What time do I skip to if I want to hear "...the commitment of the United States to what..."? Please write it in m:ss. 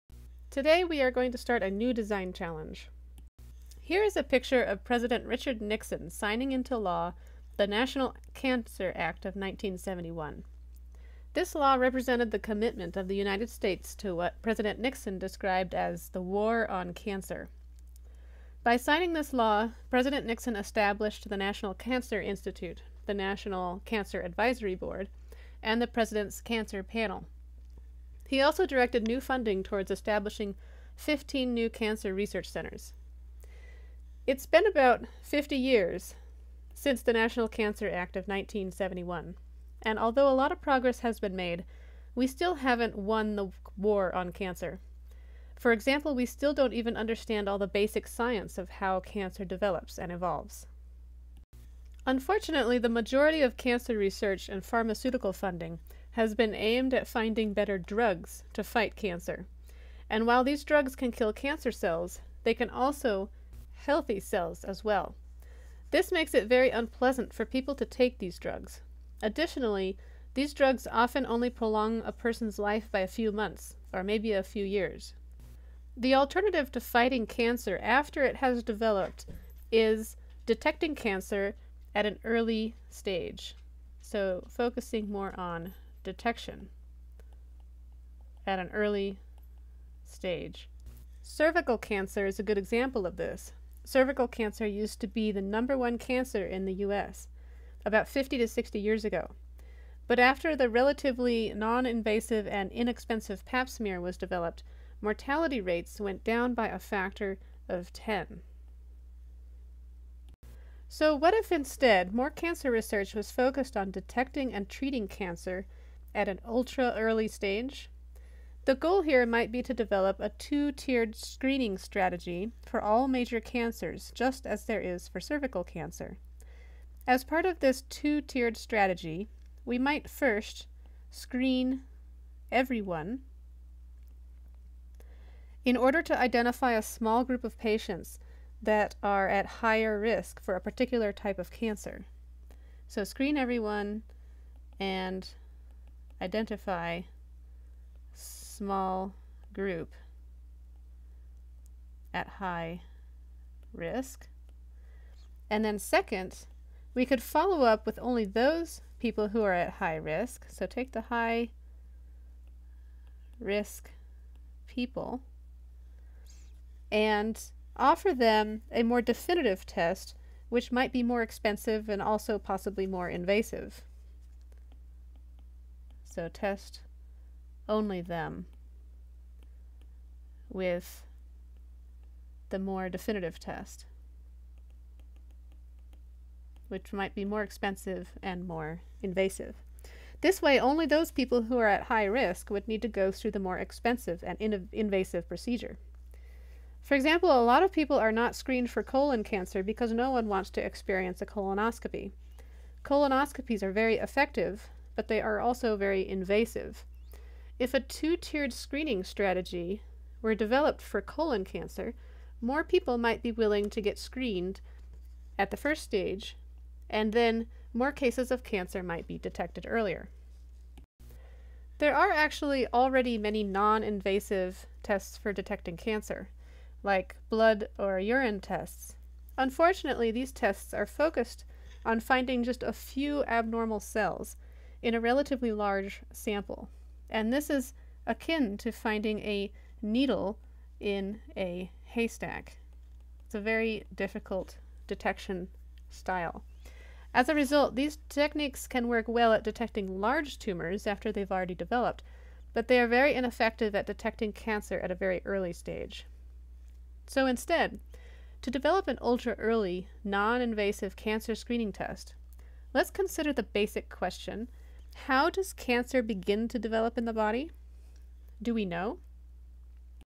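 0:12.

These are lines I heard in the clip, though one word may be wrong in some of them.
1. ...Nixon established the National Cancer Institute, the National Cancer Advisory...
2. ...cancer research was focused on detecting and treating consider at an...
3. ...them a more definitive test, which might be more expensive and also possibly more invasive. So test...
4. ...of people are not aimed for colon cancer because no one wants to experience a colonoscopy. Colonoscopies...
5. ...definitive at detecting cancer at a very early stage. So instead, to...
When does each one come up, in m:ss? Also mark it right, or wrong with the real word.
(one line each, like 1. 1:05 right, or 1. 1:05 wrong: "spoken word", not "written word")
1. 0:20 right
2. 1:52 wrong: "cancer", not "consider"
3. 2:48 right
4. 3:17 wrong: "screened", not "aimed"
5. 4:13 wrong: "ineffective", not "definitive".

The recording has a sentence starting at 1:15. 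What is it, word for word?
The alternative to fighting cancer after it has developed is detecting cancer at an early stage.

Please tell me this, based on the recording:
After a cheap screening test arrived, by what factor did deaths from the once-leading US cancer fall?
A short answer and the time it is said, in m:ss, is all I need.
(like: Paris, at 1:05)
10, at 1:46.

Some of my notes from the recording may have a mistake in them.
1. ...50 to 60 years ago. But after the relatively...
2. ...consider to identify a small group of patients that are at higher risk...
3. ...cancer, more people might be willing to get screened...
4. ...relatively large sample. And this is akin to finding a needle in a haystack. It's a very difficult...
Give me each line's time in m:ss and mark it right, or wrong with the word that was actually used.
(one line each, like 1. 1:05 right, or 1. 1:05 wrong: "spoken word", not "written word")
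1. 1:38 right
2. 2:15 wrong: "order", not "consider"
3. 3:31 right
4. 3:55 right.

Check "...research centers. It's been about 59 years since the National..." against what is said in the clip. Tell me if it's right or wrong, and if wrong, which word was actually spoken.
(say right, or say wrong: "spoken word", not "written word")
wrong: "50", not "59".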